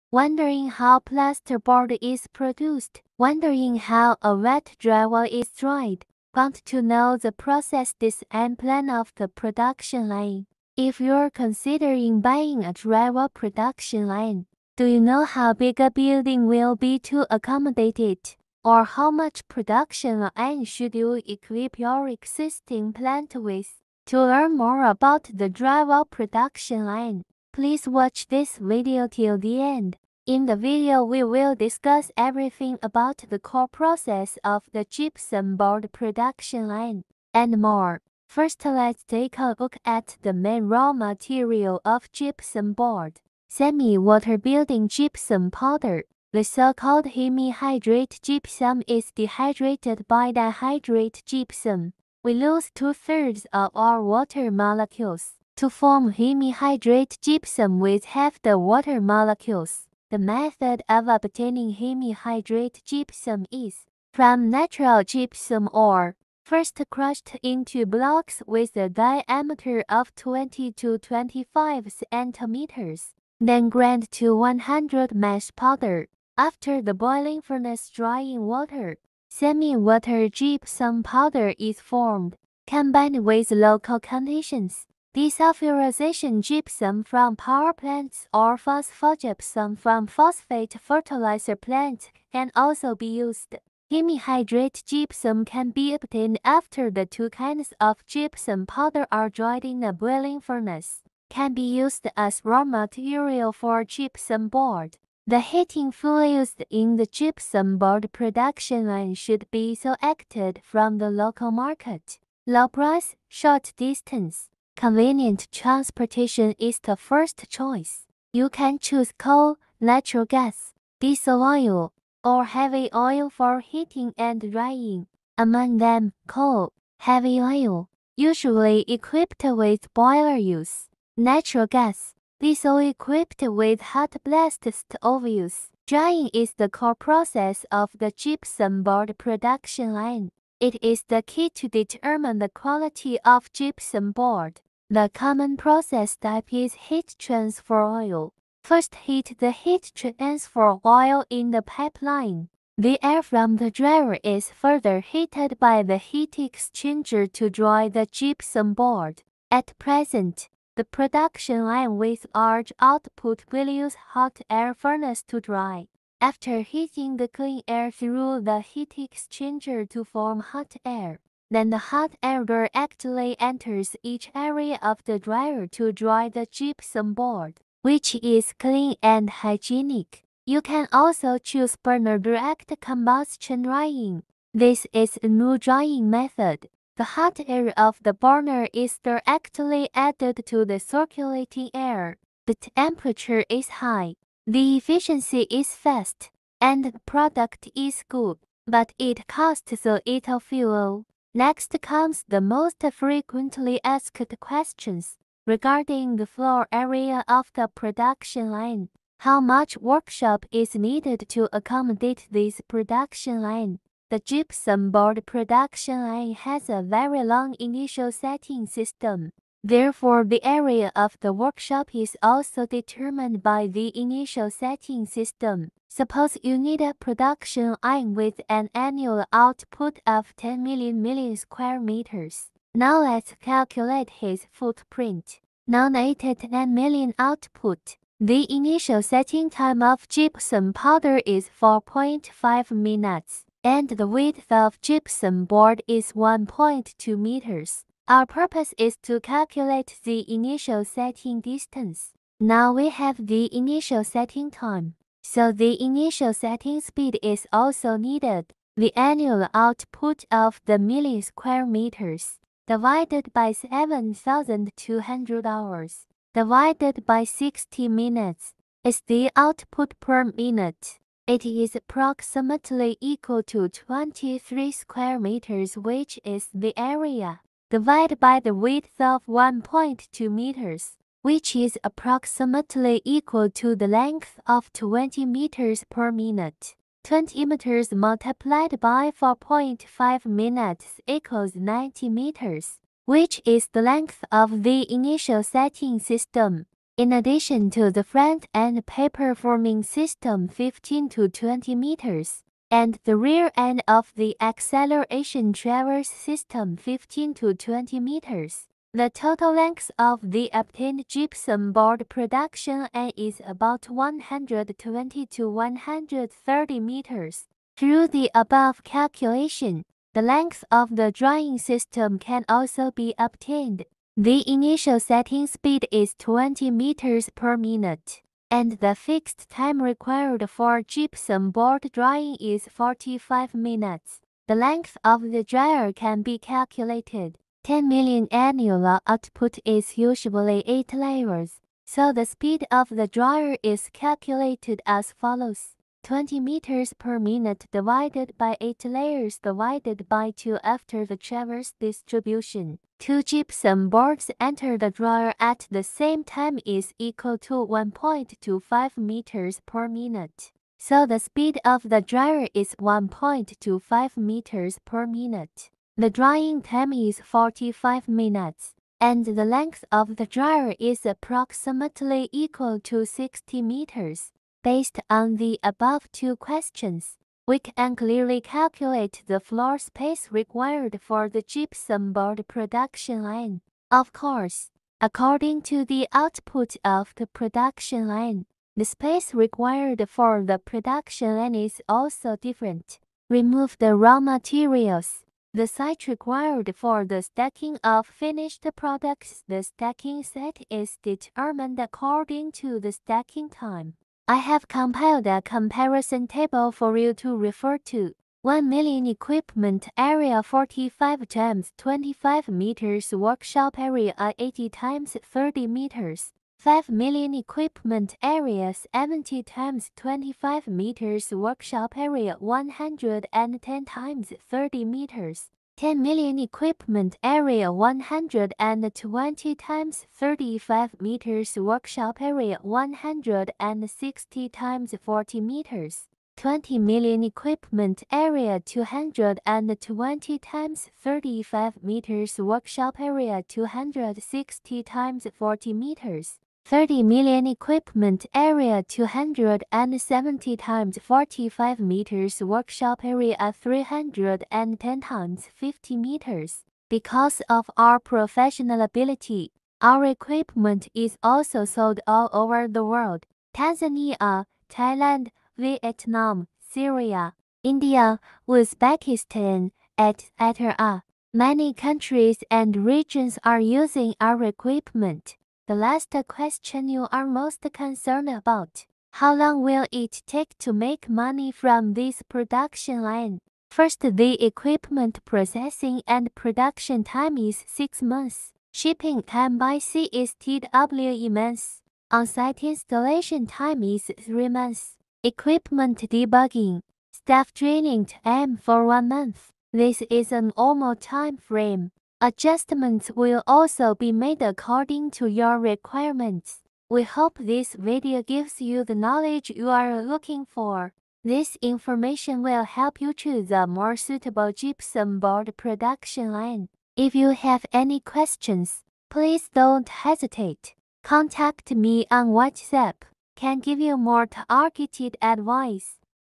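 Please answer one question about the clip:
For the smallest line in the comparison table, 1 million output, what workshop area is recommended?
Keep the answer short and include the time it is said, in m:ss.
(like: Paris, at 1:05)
80 by 30 meters, at 6:54.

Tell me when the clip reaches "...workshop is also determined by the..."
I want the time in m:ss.
3:41.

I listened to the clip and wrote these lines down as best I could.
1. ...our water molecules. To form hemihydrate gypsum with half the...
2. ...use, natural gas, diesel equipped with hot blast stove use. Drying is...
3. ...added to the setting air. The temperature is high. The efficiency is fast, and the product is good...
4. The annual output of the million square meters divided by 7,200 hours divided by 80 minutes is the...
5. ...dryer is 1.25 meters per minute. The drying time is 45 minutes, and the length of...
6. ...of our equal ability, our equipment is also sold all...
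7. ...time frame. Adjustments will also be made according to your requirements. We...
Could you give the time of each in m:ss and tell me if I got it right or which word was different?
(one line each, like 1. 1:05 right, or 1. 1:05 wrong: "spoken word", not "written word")
1. 0:53 right
2. 2:10 right
3. 3:09 wrong: "circulating", not "setting"
4. 4:18 wrong: "60", not "80"
5. 6:02 right
6. 7:37 wrong: "professional", not "equal"
7. 8:20 right.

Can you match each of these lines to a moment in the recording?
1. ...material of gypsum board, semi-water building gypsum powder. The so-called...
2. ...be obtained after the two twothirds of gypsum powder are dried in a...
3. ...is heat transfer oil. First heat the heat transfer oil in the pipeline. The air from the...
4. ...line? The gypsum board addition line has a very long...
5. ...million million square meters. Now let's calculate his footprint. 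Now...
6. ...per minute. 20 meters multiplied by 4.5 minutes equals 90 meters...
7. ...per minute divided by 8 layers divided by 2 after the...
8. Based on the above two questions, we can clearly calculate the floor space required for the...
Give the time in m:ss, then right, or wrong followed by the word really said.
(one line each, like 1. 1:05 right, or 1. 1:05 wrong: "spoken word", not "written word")
1. 0:40 right
2. 1:35 wrong: "kinds", not "twothirds"
3. 2:26 right
4. 3:33 wrong: "production", not "addition"
5. 3:50 right
6. 4:45 right
7. 5:46 right
8. 6:14 right.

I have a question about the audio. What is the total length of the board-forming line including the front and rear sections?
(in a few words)
120 to 130 meters.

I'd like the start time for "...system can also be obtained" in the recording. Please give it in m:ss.
5:21.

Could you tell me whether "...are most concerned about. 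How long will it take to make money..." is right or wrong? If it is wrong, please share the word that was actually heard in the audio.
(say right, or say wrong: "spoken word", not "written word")
right.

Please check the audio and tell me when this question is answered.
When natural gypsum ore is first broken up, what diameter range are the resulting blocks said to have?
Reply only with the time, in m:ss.
1:10.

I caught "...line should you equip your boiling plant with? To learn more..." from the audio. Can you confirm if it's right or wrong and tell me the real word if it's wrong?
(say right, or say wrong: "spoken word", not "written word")
wrong: "existing", not "boiling".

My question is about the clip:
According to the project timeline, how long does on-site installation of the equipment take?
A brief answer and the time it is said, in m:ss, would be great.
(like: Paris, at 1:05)
3 months, at 8:14.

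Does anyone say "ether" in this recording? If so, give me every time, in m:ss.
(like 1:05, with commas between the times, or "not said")
not said.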